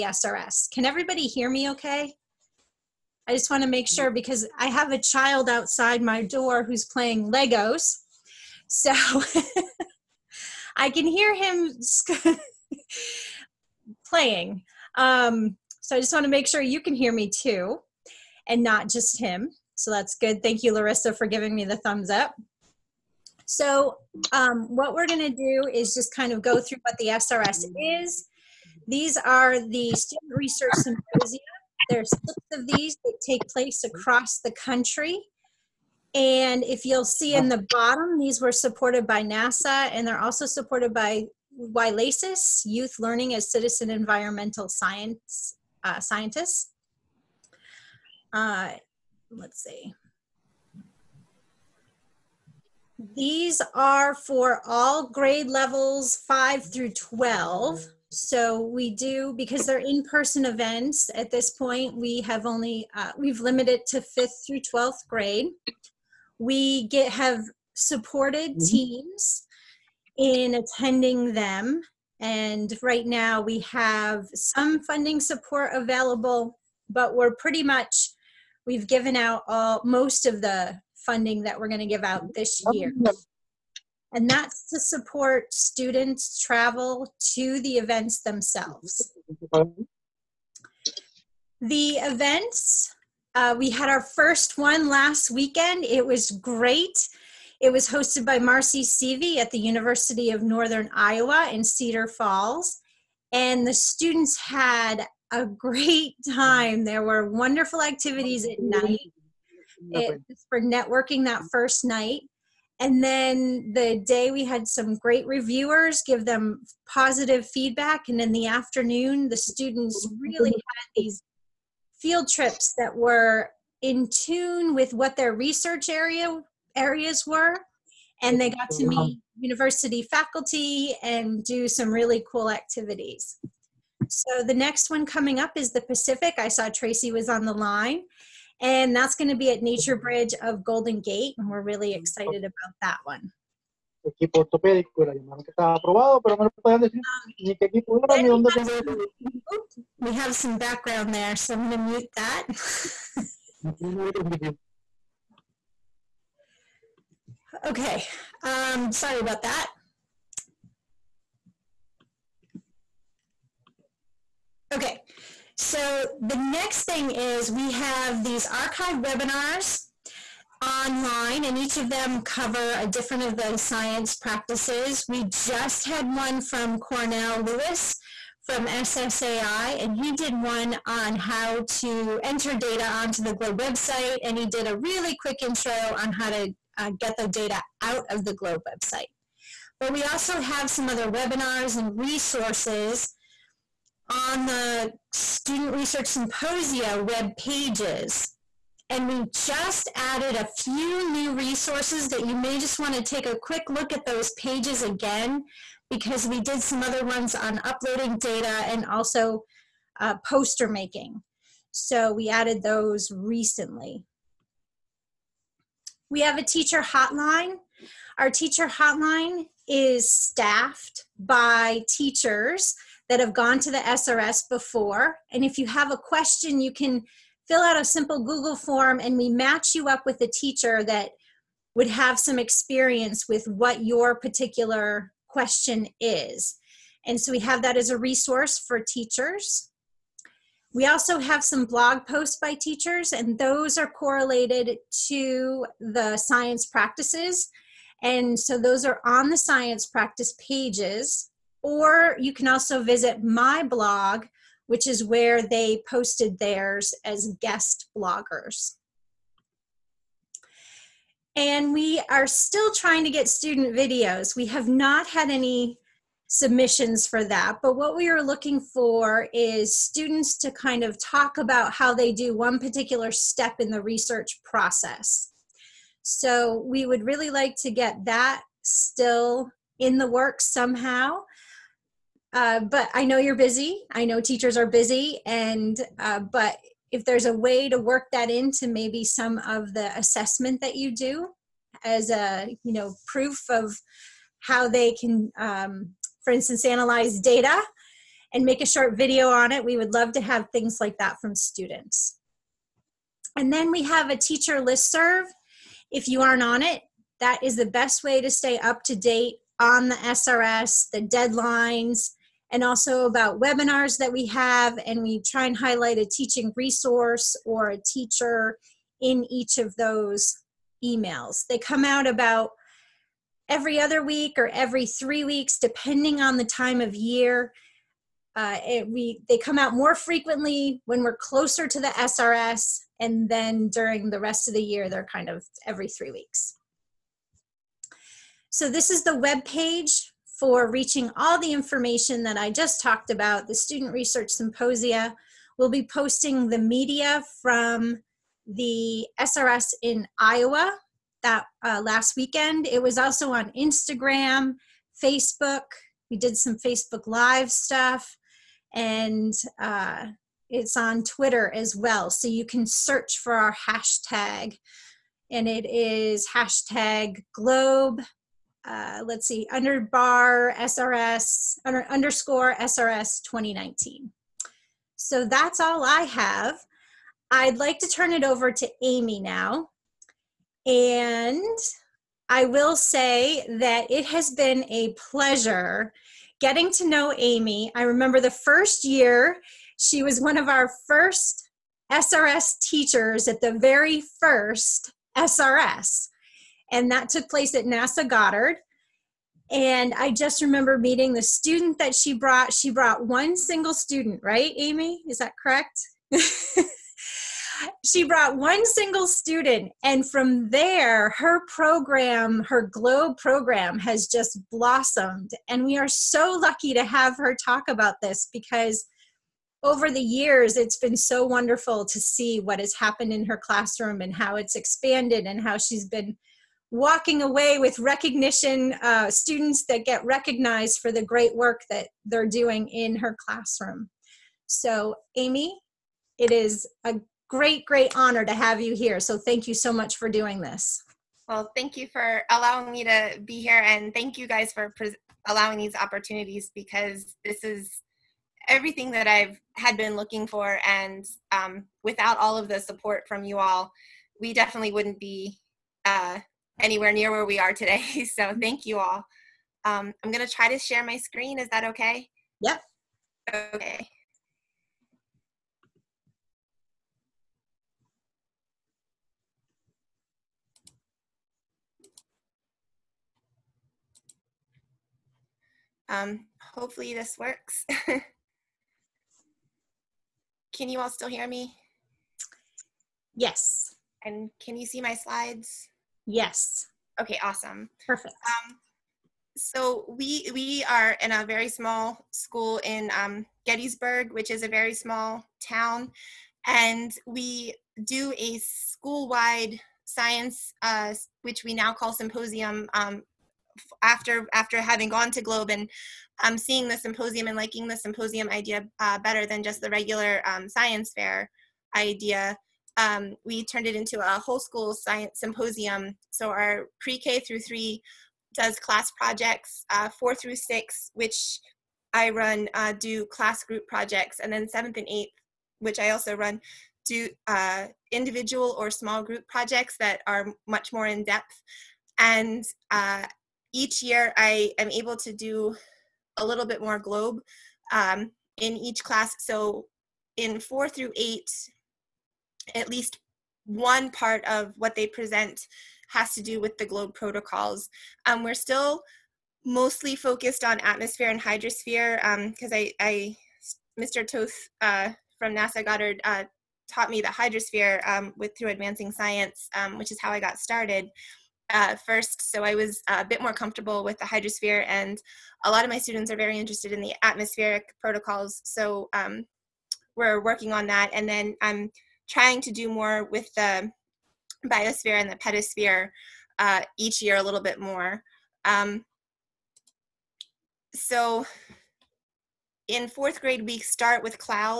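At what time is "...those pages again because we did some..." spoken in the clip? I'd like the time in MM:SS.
03:24.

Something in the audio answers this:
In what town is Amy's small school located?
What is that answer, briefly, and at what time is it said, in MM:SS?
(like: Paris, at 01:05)
Gettysburg, at 08:13.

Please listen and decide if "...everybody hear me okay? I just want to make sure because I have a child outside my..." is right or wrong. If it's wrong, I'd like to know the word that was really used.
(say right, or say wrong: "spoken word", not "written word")
right.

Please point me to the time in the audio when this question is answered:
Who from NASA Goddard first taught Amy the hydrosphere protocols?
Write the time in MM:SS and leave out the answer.
09:13.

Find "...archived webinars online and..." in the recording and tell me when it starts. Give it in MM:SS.
02:48.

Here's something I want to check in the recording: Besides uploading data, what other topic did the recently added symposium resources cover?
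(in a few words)
Poster making.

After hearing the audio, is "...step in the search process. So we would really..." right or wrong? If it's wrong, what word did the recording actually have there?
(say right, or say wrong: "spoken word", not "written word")
wrong: "research", not "search".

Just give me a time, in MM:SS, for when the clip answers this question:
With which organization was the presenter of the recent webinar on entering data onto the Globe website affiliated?
02:58.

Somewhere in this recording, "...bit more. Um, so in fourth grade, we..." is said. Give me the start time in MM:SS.
09:37.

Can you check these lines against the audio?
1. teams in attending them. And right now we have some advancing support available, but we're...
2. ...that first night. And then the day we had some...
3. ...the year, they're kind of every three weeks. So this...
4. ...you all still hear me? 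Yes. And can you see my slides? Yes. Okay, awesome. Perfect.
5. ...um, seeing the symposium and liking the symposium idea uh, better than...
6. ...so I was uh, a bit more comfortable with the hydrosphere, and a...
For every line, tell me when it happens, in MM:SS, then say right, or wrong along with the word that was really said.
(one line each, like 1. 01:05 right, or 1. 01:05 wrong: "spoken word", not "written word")
1. 01:08 wrong: "funding", not "advancing"
2. 01:51 right
3. 05:34 right
4. 08:00 right
5. 08:26 right
6. 09:22 right.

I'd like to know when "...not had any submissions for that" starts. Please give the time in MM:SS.
04:24.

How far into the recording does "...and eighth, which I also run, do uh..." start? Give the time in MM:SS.
08:44.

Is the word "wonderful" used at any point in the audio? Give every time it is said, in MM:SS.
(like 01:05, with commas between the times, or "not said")
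01:47, 07:01.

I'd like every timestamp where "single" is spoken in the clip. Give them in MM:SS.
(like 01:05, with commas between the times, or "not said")
06:43, 06:48.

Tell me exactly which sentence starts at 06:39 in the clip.
And I just remember meeting the student that she brought.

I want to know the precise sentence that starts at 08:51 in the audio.
And uh, each year I am able to do a little bit more globe um, in each class.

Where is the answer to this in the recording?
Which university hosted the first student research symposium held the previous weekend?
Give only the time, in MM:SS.
01:39.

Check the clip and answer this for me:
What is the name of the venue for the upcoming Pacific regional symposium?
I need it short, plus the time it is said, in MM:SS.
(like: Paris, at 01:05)
NatureBridge of Golden Gate, at 02:19.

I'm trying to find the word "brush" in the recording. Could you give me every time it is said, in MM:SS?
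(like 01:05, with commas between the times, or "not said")
not said.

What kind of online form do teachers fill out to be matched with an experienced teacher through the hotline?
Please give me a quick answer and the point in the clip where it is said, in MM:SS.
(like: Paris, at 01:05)
Google form, at 03:48.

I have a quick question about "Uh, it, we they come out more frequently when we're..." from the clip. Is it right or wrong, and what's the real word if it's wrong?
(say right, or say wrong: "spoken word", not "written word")
right.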